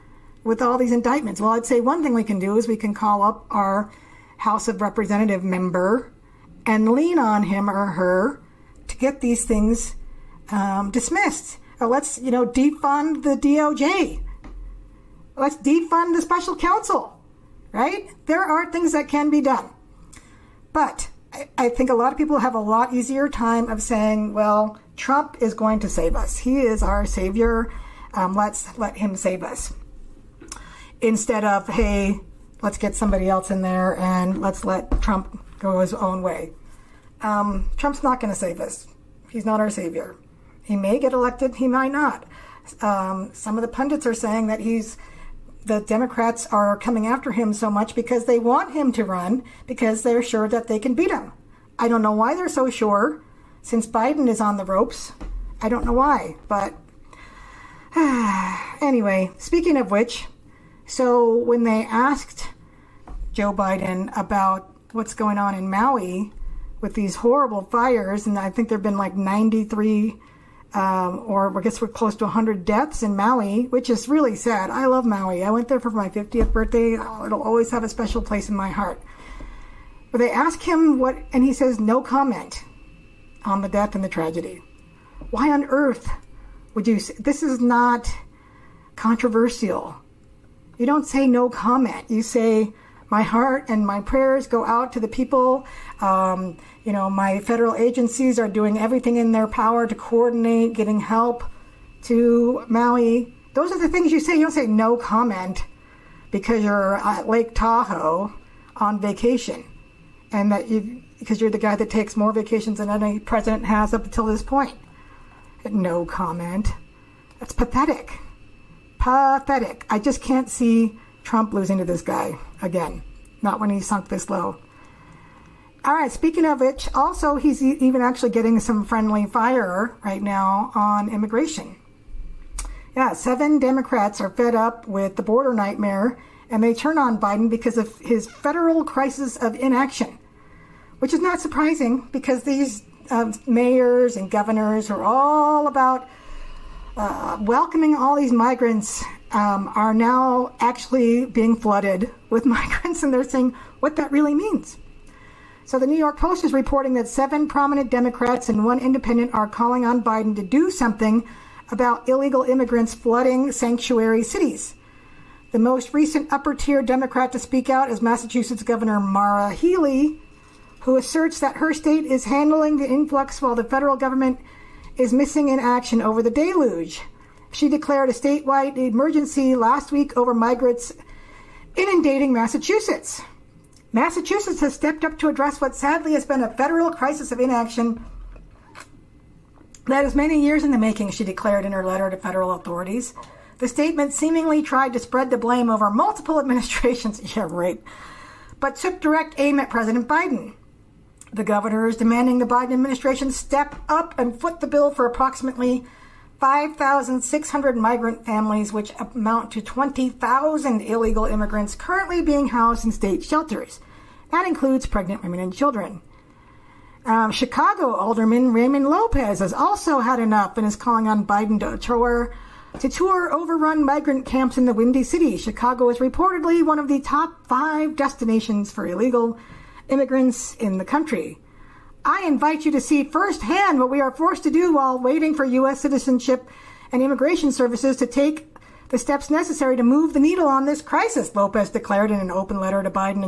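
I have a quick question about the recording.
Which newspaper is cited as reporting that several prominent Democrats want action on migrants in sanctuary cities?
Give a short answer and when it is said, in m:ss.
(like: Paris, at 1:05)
New York Post, at 2:35.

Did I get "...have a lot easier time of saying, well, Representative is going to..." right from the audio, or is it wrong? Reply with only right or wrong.
wrong.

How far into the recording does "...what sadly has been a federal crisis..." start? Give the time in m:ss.
3:05.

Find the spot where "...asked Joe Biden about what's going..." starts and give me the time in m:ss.
1:01.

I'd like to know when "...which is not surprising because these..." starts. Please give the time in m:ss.
2:21.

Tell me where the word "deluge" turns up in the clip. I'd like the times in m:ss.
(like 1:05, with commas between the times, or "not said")
2:56.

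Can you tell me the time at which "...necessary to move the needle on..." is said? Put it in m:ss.
3:59.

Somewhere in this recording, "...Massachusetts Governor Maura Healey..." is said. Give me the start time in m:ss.
2:48.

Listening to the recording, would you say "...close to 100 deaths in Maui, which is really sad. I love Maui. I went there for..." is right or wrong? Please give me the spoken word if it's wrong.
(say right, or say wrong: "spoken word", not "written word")
right.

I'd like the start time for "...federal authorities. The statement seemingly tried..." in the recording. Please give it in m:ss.
3:12.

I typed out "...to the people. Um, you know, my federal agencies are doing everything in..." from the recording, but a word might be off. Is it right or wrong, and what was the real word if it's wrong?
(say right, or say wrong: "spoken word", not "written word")
right.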